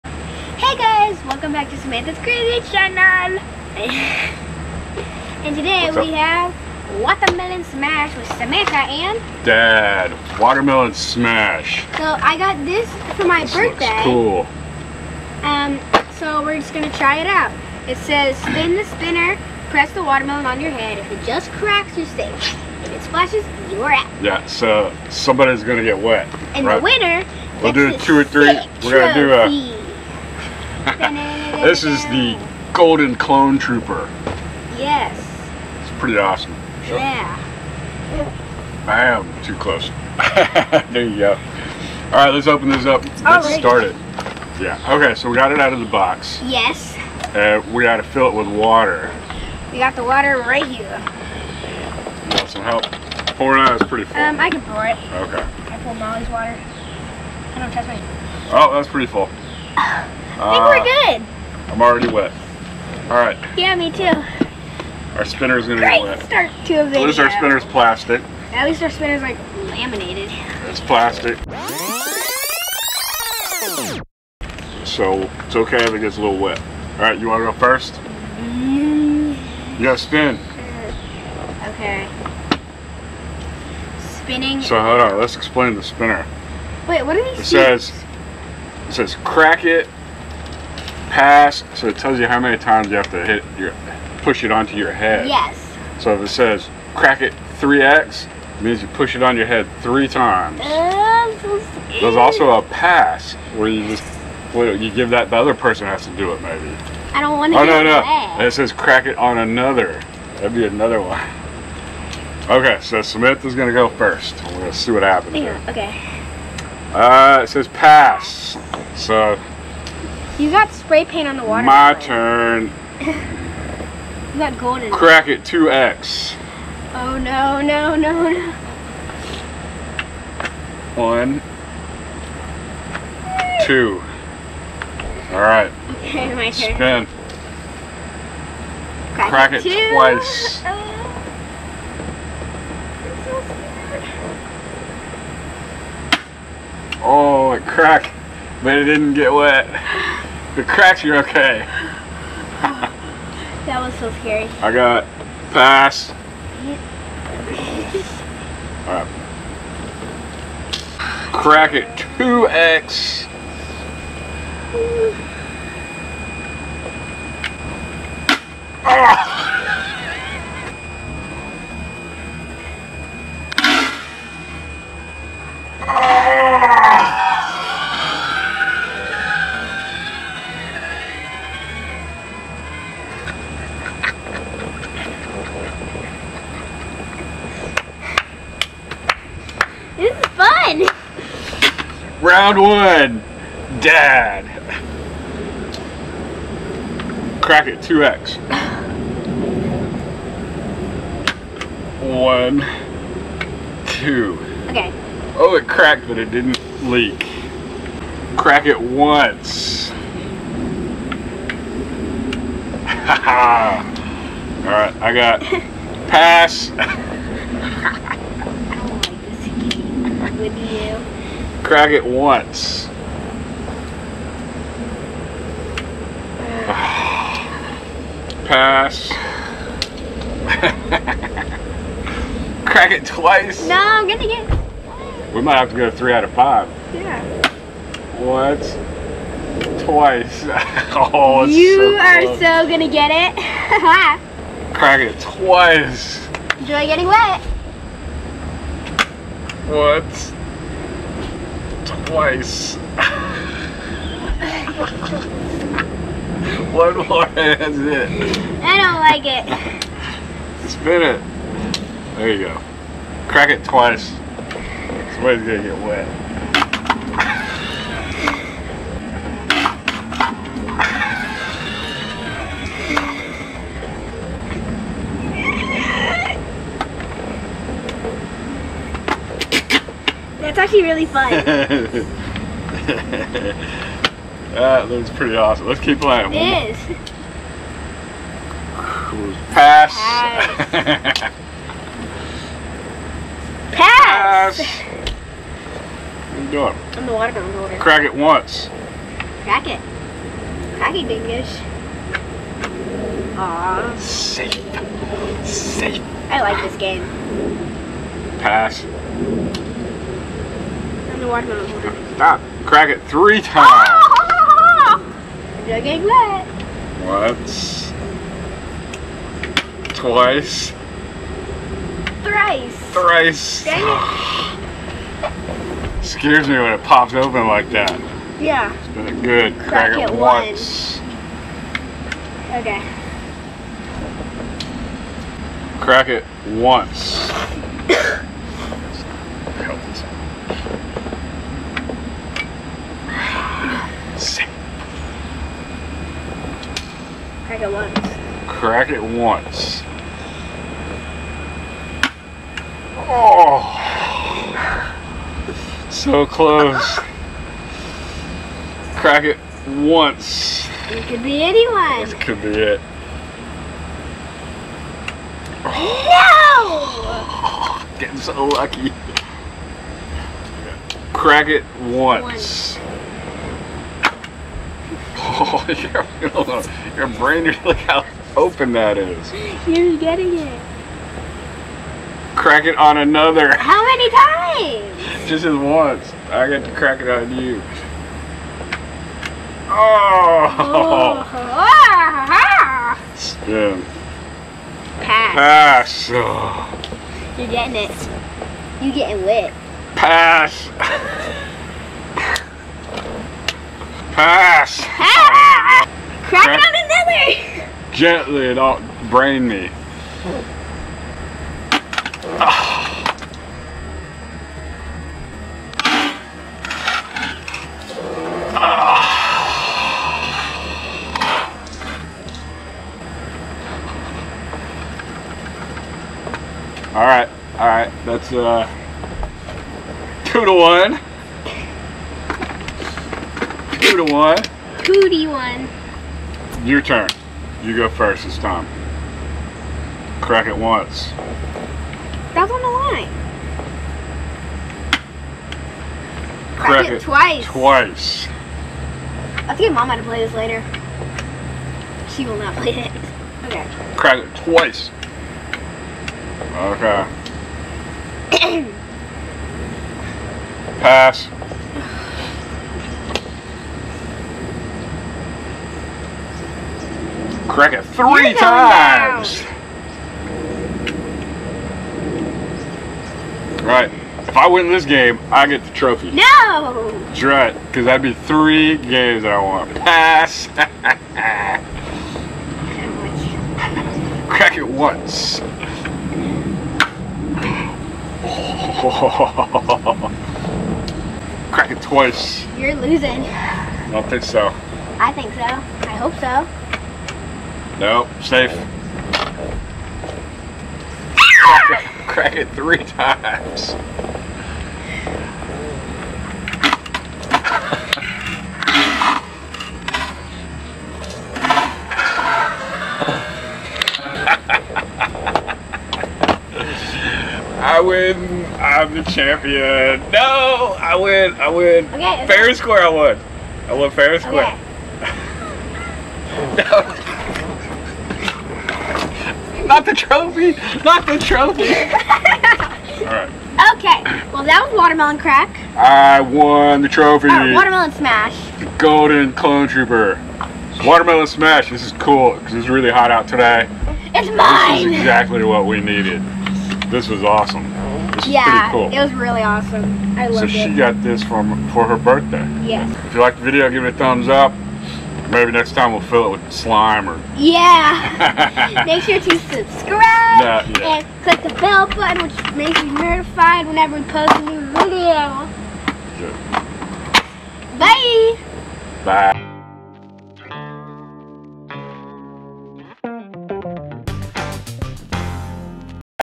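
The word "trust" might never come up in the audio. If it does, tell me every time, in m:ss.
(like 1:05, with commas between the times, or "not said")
0:57.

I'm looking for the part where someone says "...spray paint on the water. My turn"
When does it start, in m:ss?
2:00.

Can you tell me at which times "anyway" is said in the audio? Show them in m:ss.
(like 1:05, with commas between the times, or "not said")
not said.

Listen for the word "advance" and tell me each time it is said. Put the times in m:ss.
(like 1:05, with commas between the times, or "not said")
not said.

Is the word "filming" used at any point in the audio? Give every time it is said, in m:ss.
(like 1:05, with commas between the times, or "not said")
not said.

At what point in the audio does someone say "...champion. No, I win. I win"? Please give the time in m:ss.
8:39.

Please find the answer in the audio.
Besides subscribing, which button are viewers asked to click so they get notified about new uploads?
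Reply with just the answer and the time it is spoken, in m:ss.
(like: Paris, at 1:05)
The bell button, at 9:21.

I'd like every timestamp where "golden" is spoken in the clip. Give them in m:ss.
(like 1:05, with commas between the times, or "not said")
0:32, 2:04, 8:58.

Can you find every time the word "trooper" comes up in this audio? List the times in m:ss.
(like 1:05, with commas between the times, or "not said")
0:33, 8:59.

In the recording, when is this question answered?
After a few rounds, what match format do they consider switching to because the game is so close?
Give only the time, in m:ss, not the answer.
3:55.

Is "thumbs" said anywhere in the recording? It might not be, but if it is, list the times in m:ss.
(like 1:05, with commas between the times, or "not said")
9:13.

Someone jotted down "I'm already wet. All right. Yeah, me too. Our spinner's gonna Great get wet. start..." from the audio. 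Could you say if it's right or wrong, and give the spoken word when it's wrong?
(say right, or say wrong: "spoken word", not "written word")
right.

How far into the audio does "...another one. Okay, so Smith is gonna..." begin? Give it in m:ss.
1:50.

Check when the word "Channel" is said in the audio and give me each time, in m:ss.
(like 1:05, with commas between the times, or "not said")
0:02.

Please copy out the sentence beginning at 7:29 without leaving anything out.
I think mom had to play this later.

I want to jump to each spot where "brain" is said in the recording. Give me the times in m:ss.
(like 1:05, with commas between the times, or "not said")
6:17, 6:49.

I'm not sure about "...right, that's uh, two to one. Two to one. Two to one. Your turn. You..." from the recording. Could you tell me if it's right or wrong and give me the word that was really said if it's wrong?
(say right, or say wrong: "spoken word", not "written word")
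right.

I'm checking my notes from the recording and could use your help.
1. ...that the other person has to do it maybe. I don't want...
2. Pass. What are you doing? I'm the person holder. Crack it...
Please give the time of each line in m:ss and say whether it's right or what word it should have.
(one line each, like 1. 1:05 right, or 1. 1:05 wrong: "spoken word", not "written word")
1. 1:45 right
2. 4:54 wrong: "watermelon", not "person".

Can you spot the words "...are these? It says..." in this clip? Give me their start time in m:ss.
1:27.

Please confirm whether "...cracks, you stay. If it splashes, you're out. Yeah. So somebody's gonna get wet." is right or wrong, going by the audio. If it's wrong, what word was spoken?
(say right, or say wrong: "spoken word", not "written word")
right.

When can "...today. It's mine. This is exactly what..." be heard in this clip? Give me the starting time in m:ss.
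9:03.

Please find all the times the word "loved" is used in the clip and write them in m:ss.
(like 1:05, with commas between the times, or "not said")
9:10.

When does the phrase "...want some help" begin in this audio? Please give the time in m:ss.
0:52.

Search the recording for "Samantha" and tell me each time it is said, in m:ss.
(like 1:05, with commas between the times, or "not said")
0:01, 0:08.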